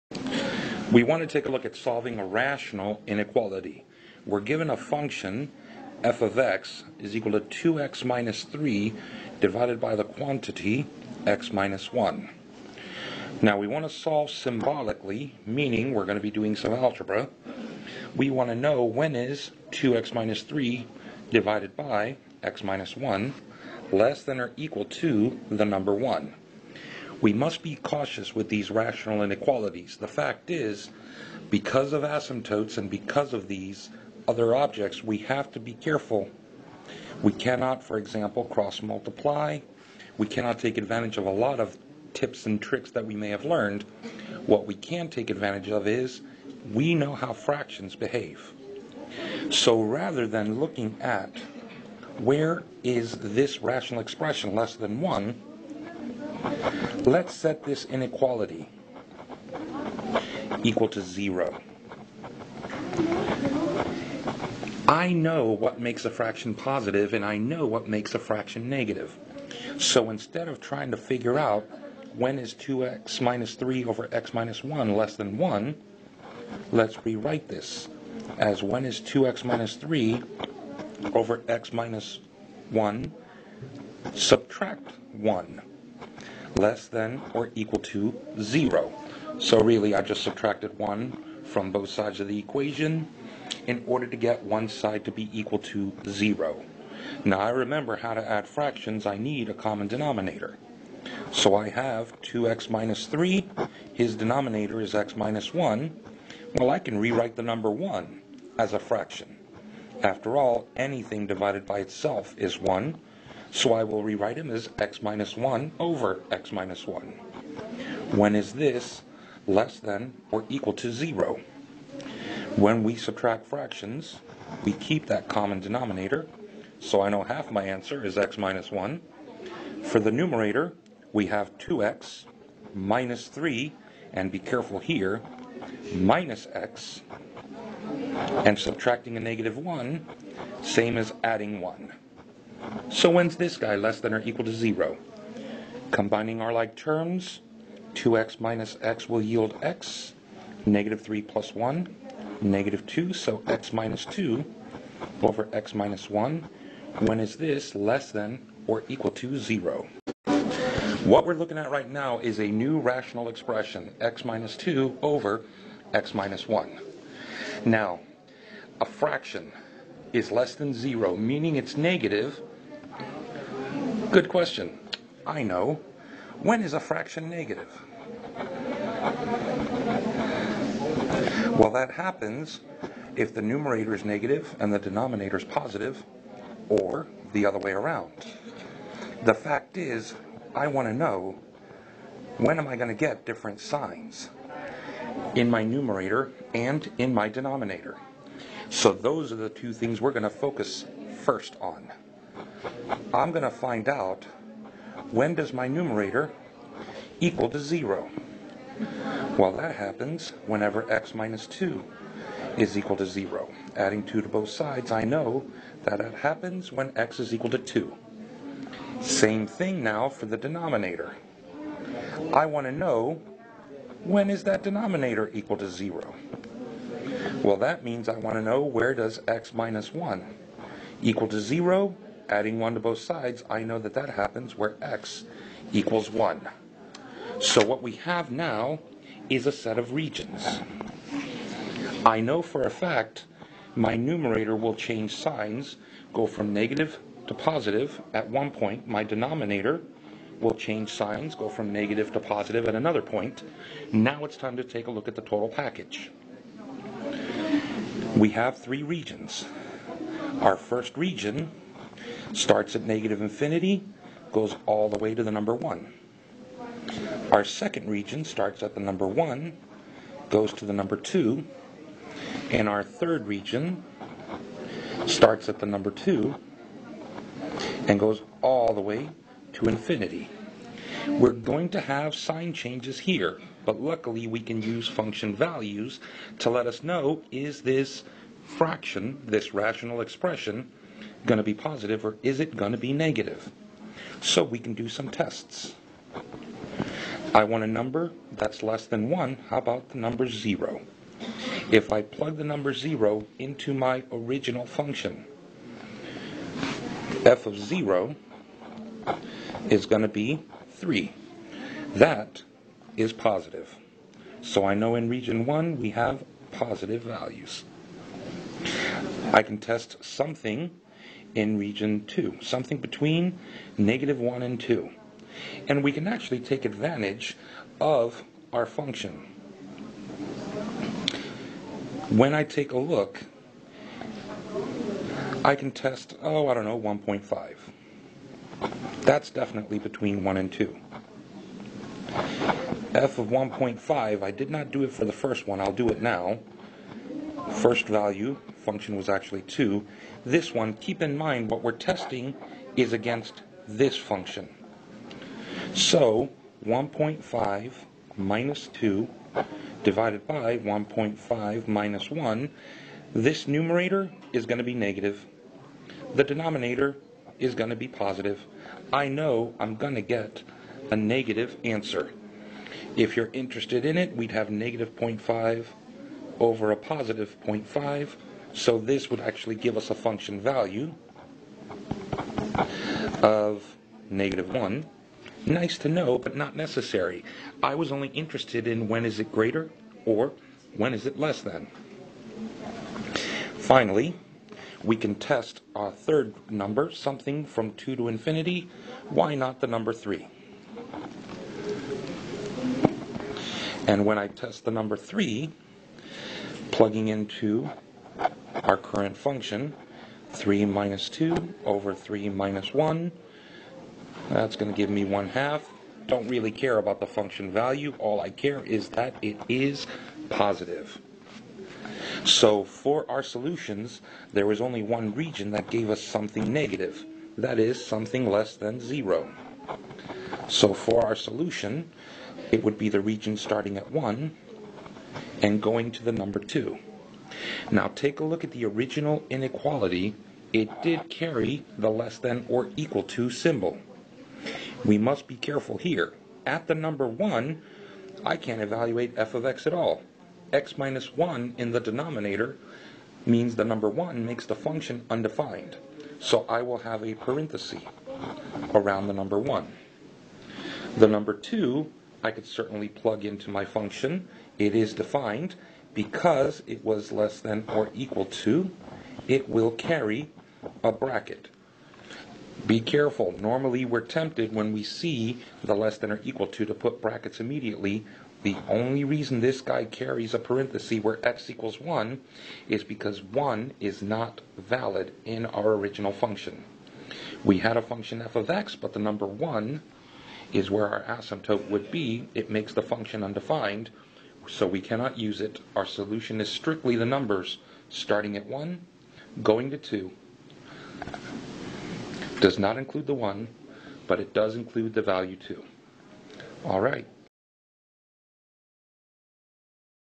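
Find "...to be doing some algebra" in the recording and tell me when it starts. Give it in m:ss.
0:16.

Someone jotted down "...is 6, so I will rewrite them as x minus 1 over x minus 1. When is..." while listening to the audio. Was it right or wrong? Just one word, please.
wrong.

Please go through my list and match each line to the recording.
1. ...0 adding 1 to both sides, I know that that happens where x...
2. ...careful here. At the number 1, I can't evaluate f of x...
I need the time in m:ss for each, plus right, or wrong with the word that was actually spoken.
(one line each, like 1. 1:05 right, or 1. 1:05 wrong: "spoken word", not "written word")
1. 3:51 right
2. 7:25 right.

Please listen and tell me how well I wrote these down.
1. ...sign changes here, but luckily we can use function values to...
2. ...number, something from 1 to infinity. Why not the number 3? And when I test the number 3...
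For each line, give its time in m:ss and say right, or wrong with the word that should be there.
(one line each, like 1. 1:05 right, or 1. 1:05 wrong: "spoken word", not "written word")
1. 4:42 right
2. 6:36 wrong: "2", not "1".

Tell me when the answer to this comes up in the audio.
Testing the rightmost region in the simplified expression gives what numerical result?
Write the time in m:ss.
6:55.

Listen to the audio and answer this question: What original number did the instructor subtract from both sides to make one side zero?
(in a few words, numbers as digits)
1.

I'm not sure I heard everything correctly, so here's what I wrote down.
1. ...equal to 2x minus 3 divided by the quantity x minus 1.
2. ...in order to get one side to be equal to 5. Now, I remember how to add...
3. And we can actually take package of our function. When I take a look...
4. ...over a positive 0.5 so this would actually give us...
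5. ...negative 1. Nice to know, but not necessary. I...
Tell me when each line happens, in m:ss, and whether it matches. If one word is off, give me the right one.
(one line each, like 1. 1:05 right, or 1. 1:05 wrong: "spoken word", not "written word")
1. 0:07 right
2. 1:33 wrong: "0", not "5"
3. 5:25 wrong: "advantage", not "package"
4. 6:16 right
5. 6:24 right.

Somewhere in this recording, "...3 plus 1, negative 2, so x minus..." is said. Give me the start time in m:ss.
2:31.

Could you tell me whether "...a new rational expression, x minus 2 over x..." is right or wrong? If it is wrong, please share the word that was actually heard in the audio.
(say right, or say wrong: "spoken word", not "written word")
right.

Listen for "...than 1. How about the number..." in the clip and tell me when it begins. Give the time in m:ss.
4:58.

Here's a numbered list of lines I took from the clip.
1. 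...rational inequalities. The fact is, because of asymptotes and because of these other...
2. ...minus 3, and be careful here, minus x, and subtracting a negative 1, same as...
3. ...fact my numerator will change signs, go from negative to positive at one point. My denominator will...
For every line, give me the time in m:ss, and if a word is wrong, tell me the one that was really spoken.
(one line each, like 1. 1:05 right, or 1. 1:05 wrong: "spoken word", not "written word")
1. 0:28 right
2. 2:12 right
3. 4:02 right.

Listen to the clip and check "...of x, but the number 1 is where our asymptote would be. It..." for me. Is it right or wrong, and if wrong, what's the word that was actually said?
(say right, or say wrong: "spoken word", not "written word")
right.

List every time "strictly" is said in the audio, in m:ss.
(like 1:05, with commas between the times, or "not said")
8:16.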